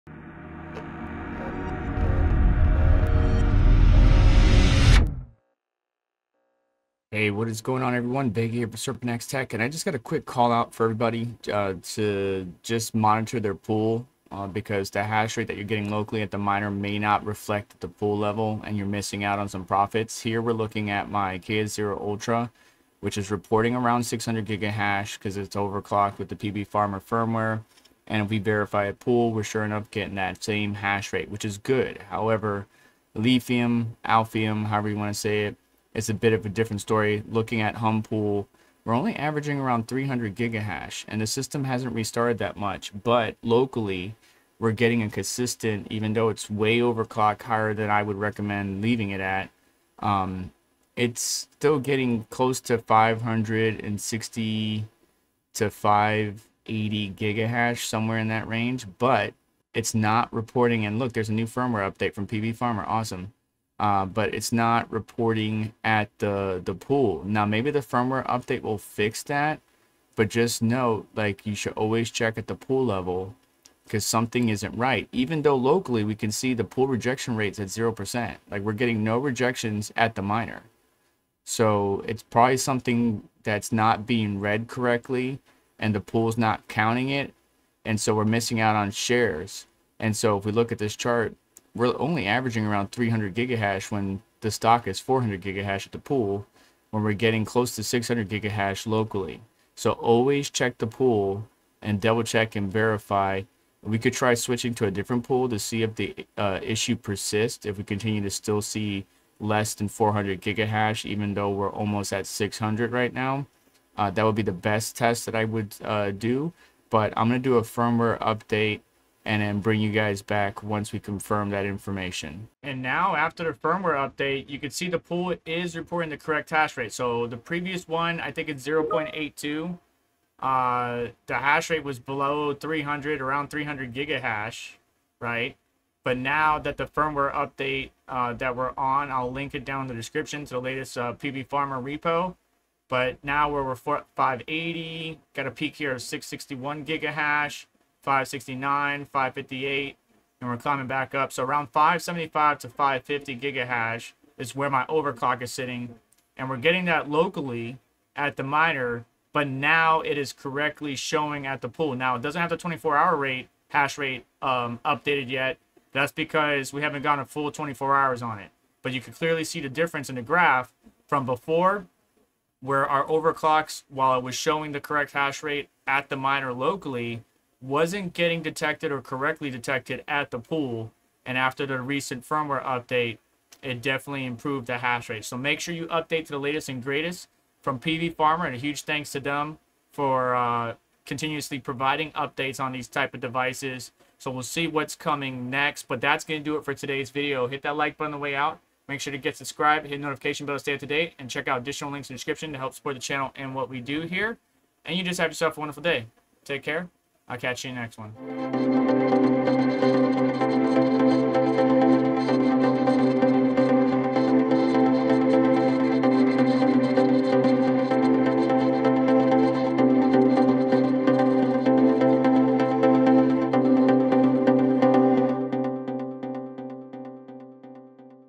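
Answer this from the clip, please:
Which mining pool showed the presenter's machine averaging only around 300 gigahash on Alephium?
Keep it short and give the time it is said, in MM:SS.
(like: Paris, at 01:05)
Humpool, at 00:37.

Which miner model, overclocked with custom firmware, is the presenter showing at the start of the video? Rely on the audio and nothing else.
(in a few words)
KS0 Ultra.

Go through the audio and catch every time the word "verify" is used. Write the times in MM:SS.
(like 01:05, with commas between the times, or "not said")
00:28, 01:42.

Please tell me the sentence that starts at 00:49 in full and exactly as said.
Um, it's still getting close to 560 to 580 gigahash, somewhere in that range.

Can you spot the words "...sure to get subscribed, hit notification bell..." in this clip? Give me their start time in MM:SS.
03:18.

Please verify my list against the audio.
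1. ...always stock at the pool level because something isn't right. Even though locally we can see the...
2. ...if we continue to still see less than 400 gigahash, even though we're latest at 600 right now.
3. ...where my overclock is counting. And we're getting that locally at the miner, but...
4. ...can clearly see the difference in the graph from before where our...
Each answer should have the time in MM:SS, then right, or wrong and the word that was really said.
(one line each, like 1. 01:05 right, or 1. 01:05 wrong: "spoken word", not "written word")
1. 01:11 wrong: "check", not "stock"
2. 01:47 wrong: "almost", not "latest"
3. 02:34 wrong: "sitting", not "counting"
4. 02:49 right.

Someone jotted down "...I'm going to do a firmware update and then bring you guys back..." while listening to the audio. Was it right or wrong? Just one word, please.
right.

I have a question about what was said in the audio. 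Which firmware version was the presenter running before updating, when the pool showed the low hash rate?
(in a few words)
0.82.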